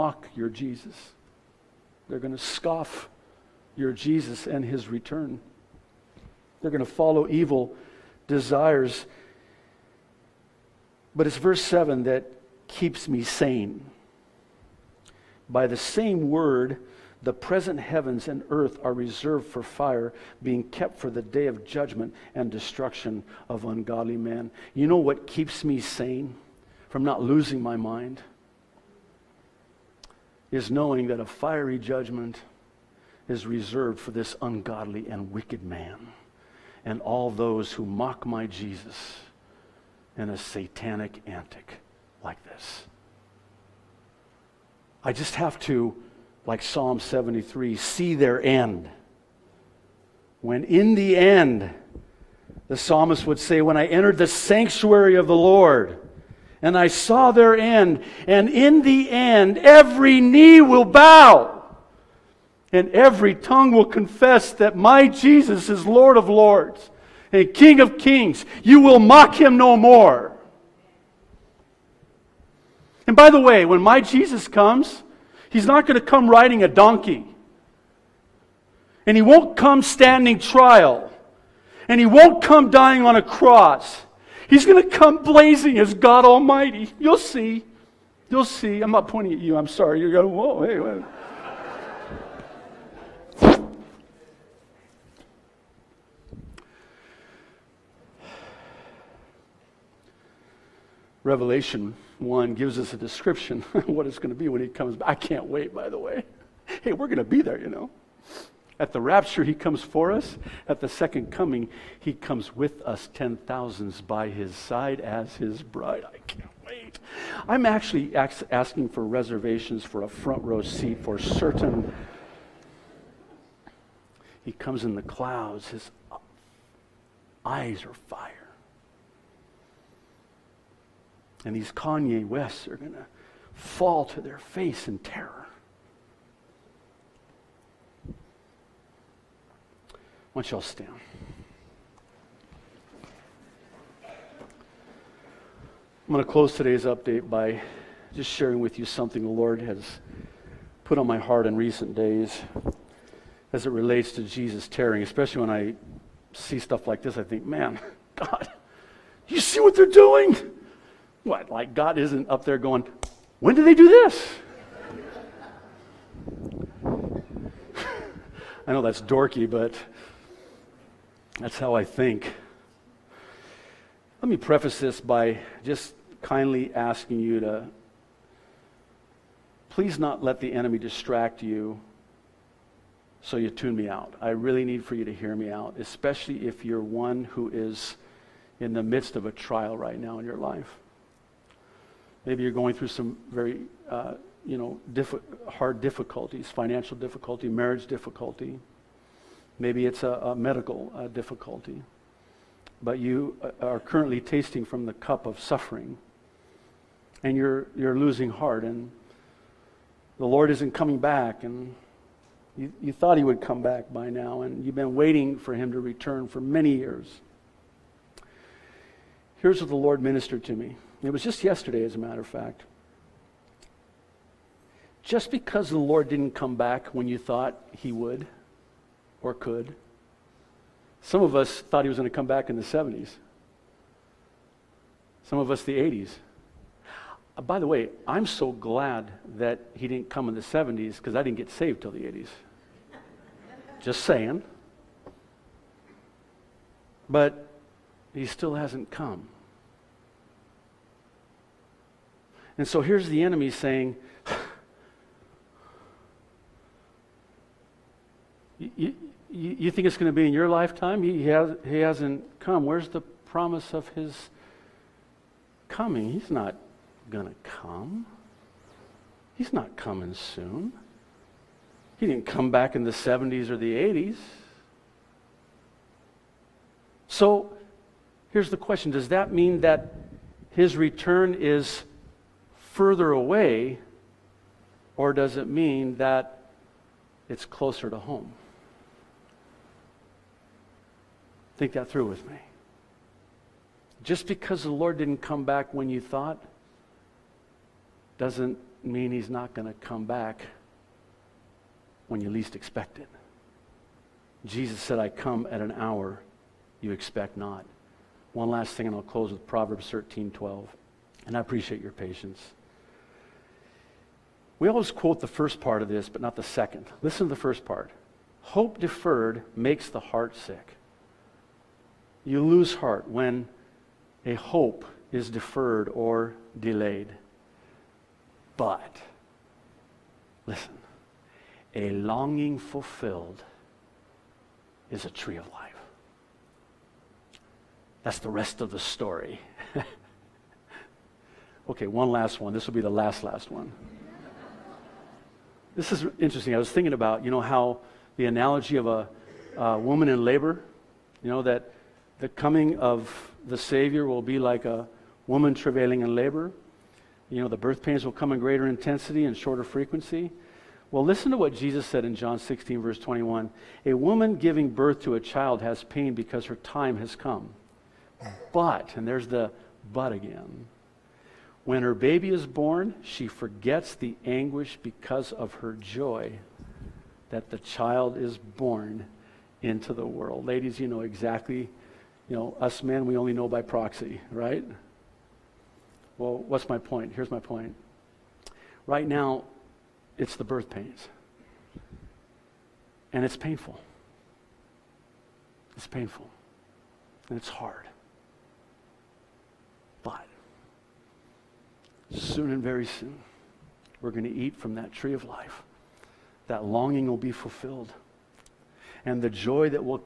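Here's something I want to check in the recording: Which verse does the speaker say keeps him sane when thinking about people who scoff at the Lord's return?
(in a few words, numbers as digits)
7.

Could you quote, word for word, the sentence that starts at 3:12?
Maybe you're going through some very, uh, you know, diff- hard difficulties, financial difficulty, marriage difficulty.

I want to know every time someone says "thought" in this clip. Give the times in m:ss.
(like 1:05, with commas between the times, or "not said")
3:32, 3:47, 3:51, 4:56.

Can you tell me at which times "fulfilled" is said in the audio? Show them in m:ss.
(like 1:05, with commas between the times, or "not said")
5:32, 6:47.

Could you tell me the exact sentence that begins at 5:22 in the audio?
You lose heart when a hope is deferred or delayed.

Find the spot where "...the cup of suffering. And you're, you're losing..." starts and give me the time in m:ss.
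3:24.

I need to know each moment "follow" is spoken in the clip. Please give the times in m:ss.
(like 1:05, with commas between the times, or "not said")
0:06.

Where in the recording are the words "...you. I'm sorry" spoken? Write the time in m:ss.
1:29.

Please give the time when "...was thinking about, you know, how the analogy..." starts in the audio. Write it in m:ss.
5:46.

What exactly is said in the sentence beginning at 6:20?
Ladies, you know exactly, you know, us men, we only know by proxy, right?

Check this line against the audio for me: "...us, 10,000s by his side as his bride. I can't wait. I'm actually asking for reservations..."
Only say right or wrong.
right.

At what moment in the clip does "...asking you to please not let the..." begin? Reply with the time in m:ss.
2:56.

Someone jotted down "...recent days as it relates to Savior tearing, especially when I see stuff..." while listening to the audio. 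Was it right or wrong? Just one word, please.
wrong.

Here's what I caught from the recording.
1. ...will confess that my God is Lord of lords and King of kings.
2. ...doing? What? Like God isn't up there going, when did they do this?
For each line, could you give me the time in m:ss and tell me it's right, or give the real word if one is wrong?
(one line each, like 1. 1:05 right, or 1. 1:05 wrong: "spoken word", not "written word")
1. 1:03 wrong: "Jesus", not "God"
2. 2:39 right.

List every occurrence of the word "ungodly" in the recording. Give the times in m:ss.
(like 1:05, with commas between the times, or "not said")
0:23, 0:34.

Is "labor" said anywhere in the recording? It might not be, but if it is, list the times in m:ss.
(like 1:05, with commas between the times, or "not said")
5:50, 5:56.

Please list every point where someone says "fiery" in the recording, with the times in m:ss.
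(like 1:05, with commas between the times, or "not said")
0:31.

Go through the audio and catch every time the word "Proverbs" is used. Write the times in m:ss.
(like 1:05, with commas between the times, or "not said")
5:09.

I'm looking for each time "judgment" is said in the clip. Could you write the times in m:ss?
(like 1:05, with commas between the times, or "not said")
0:21, 0:31.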